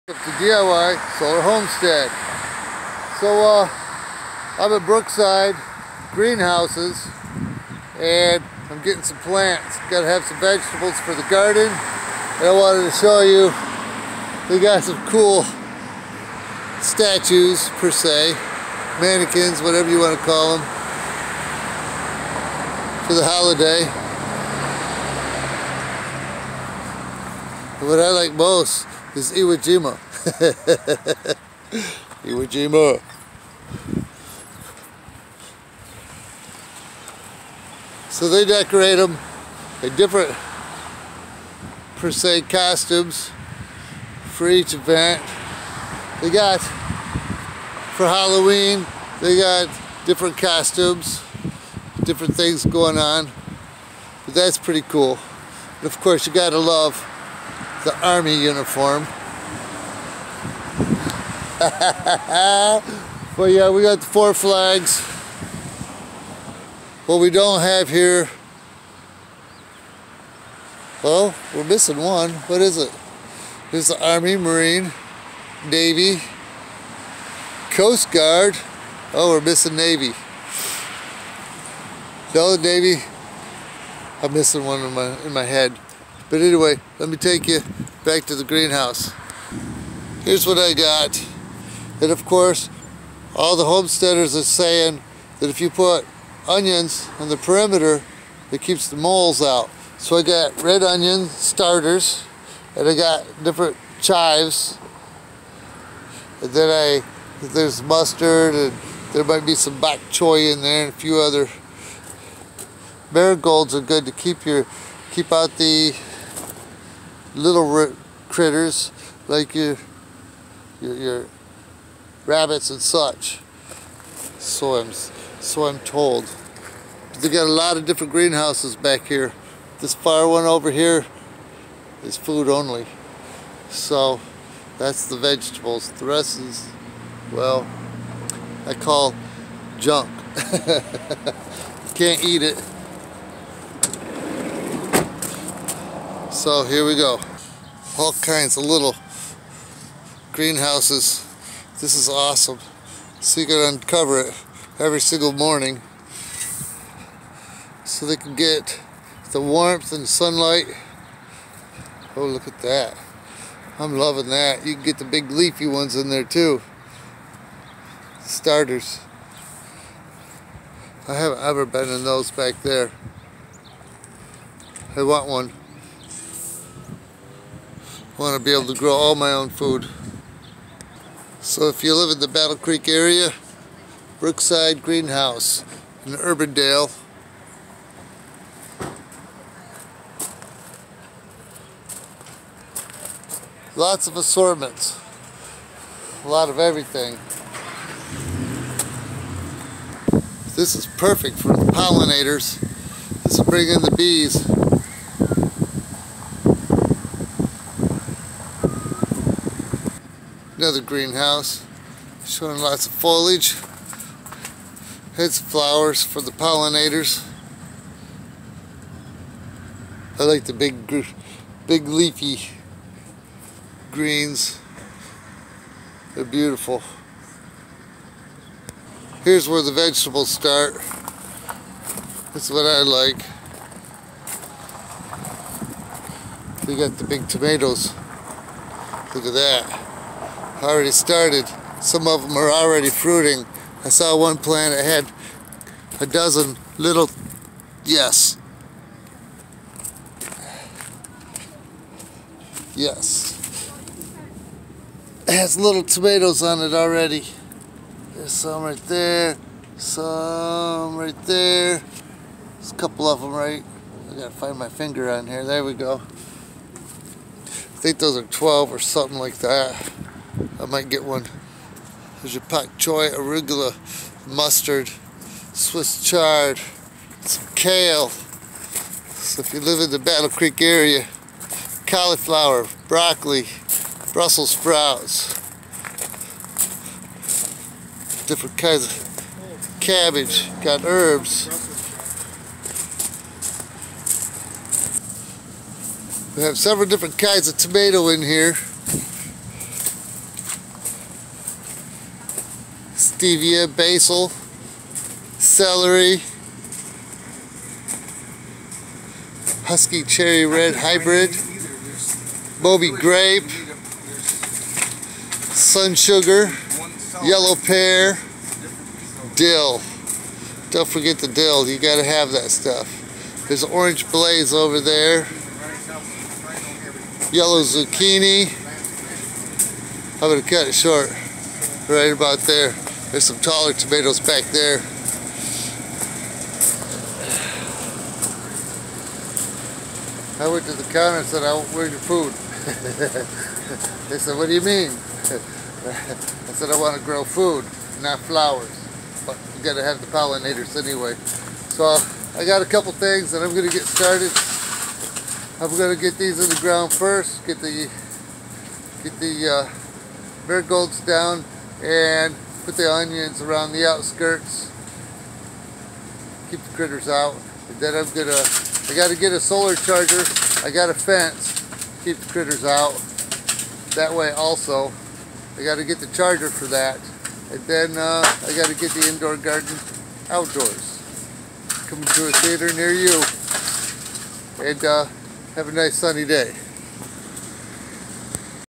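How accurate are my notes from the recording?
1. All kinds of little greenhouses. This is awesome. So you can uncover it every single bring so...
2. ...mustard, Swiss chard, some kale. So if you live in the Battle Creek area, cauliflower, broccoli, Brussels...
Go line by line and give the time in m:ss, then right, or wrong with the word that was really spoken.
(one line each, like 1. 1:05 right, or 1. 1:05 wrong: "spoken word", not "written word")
1. 2:27 wrong: "morning", not "bring"
2. 4:34 right.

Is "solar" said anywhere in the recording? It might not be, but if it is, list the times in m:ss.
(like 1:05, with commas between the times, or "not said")
0:01, 6:09.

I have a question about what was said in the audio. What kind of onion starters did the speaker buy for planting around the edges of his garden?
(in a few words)
red onion.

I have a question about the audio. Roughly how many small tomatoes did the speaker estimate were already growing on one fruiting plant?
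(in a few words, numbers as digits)
12.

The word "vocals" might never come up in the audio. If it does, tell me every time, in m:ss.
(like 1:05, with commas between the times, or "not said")
not said.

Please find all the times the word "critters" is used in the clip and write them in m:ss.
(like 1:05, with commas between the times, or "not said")
1:58, 6:06, 6:12.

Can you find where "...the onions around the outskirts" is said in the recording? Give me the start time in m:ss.
6:02.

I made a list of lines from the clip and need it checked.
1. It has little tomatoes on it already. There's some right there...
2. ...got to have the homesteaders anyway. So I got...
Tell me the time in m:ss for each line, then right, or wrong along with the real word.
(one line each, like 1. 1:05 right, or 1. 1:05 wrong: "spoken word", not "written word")
1. 4:15 right
2. 5:49 wrong: "pollinators", not "homesteaders".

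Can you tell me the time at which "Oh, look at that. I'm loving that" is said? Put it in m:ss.
2:42.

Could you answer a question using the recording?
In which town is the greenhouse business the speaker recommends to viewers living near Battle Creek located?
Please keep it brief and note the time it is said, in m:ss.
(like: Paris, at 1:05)
Urbandale, at 3:06.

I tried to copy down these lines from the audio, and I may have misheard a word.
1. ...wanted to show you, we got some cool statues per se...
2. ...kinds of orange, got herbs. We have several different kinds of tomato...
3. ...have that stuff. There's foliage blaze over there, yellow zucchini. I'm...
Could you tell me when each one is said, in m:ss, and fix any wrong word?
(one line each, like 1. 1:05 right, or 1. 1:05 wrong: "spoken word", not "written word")
1. 0:12 right
2. 4:48 wrong: "cabbage", not "orange"
3. 5:22 wrong: "orange", not "foliage".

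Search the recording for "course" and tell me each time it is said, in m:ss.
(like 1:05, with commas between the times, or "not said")
0:55, 1:32.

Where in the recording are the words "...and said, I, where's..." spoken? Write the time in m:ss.
5:41.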